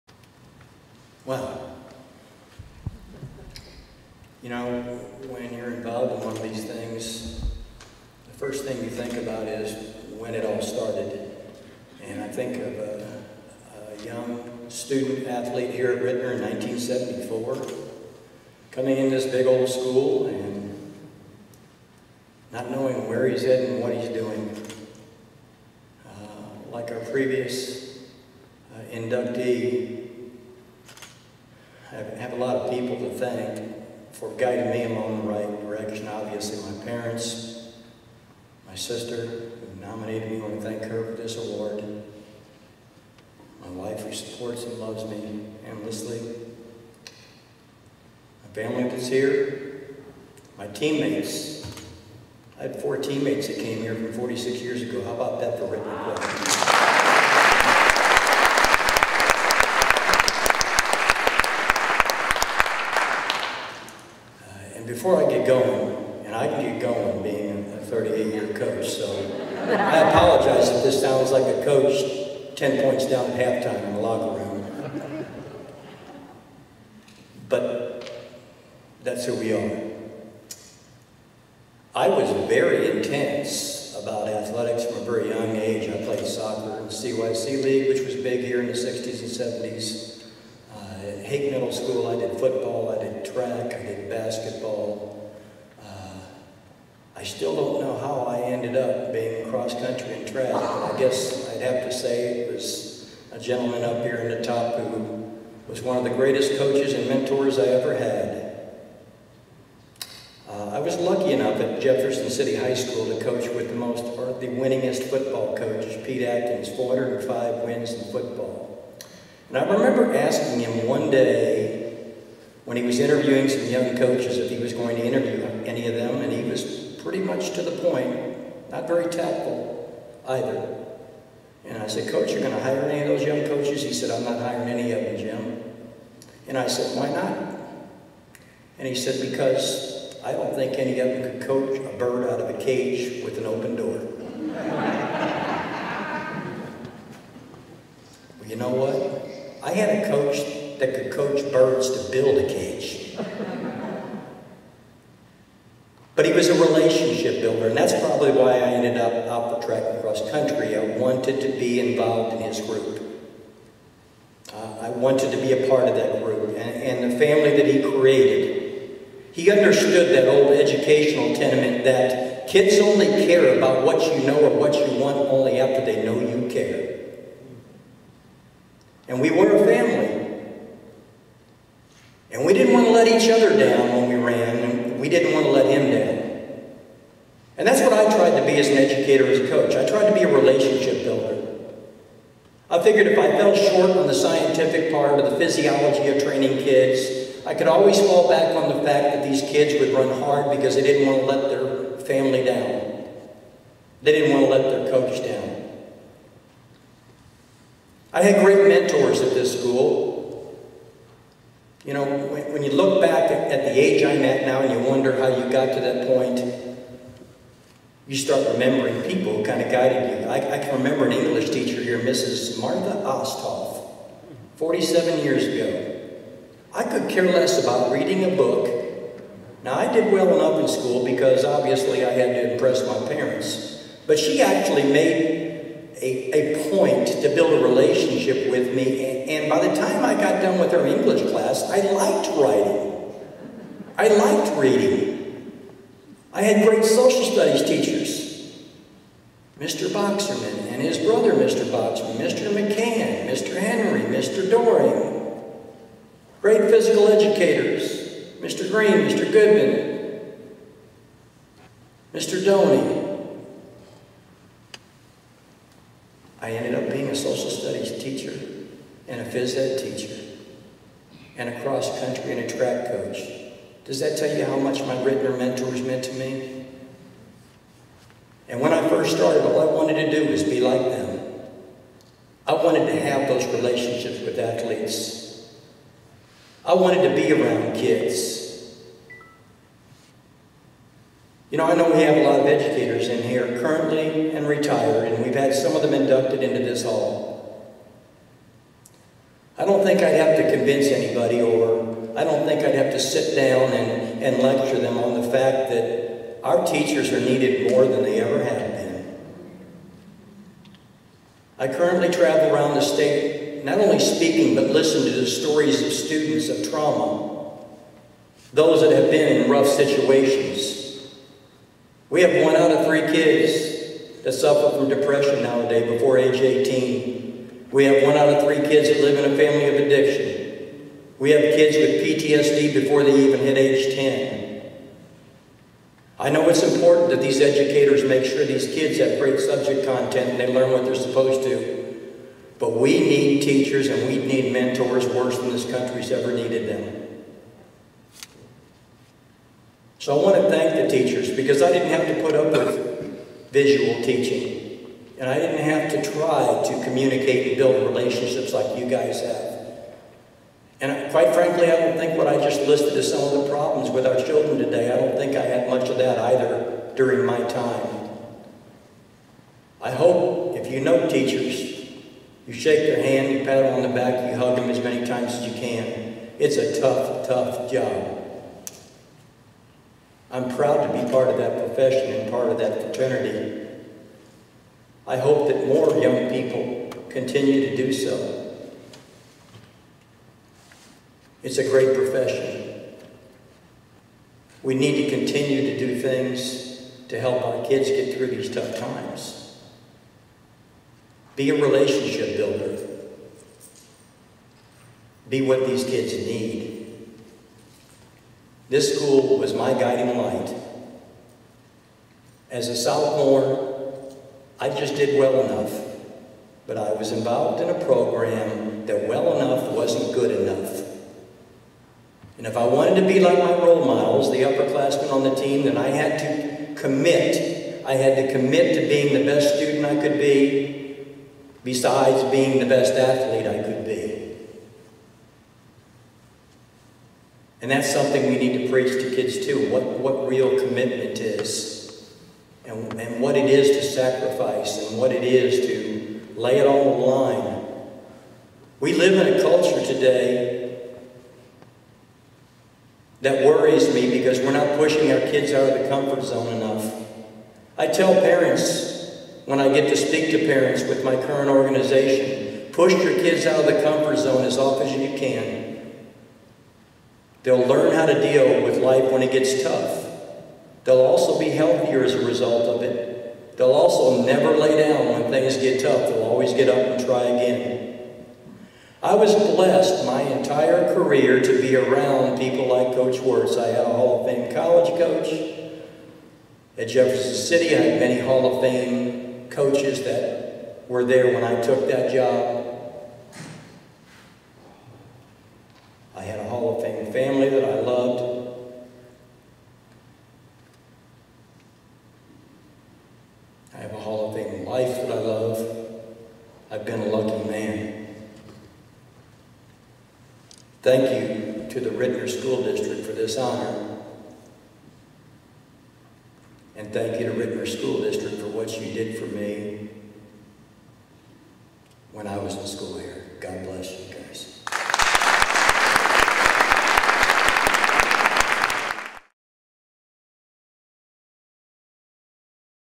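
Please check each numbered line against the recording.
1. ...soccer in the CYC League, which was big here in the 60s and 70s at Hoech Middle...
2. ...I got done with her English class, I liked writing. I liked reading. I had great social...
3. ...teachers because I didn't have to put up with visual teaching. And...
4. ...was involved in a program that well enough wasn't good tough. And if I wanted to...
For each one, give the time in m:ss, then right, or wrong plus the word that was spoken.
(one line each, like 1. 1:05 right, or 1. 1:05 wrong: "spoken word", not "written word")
1. 1:26 right
2. 4:00 right
3. 5:50 right
4. 6:56 wrong: "enough", not "tough".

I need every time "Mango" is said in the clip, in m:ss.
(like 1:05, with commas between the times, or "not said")
not said.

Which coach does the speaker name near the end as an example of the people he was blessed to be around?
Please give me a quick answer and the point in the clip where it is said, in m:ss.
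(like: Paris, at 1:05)
Coach Wirtz, at 8:02.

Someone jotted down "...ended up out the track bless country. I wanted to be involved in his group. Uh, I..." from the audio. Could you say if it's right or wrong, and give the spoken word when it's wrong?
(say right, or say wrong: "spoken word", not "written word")
wrong: "across", not "bless".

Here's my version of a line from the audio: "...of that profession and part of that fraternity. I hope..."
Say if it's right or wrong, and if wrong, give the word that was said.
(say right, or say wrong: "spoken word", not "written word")
right.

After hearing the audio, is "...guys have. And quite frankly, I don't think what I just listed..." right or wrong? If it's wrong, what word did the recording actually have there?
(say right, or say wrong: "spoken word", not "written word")
right.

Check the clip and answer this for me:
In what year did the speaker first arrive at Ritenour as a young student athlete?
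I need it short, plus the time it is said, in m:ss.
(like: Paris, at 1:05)
1974, at 0:16.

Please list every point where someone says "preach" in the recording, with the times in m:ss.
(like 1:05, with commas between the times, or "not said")
7:18.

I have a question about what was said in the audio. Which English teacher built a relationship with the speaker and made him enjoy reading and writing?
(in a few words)
Martha Osthoff.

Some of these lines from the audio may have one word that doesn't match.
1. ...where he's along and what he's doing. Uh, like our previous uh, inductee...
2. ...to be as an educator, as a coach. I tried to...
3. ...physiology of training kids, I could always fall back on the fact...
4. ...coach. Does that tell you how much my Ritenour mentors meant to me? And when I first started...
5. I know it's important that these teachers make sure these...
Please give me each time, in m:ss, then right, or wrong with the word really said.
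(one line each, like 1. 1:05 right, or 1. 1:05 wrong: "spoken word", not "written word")
1. 0:23 wrong: "heading", not "along"
2. 3:08 right
3. 3:15 right
4. 4:32 right
5. 5:36 wrong: "educators", not "teachers".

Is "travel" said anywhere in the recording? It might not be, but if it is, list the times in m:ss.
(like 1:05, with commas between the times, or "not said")
5:12.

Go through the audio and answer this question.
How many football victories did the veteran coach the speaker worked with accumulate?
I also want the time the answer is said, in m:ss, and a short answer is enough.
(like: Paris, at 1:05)
405, at 1:56.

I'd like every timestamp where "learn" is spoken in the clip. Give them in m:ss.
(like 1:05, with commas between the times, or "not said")
5:40, 7:47.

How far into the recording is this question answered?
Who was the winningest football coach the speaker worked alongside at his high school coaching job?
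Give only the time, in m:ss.
1:56.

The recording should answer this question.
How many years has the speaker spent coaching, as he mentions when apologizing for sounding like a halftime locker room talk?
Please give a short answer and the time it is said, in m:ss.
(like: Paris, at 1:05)
38, at 1:07.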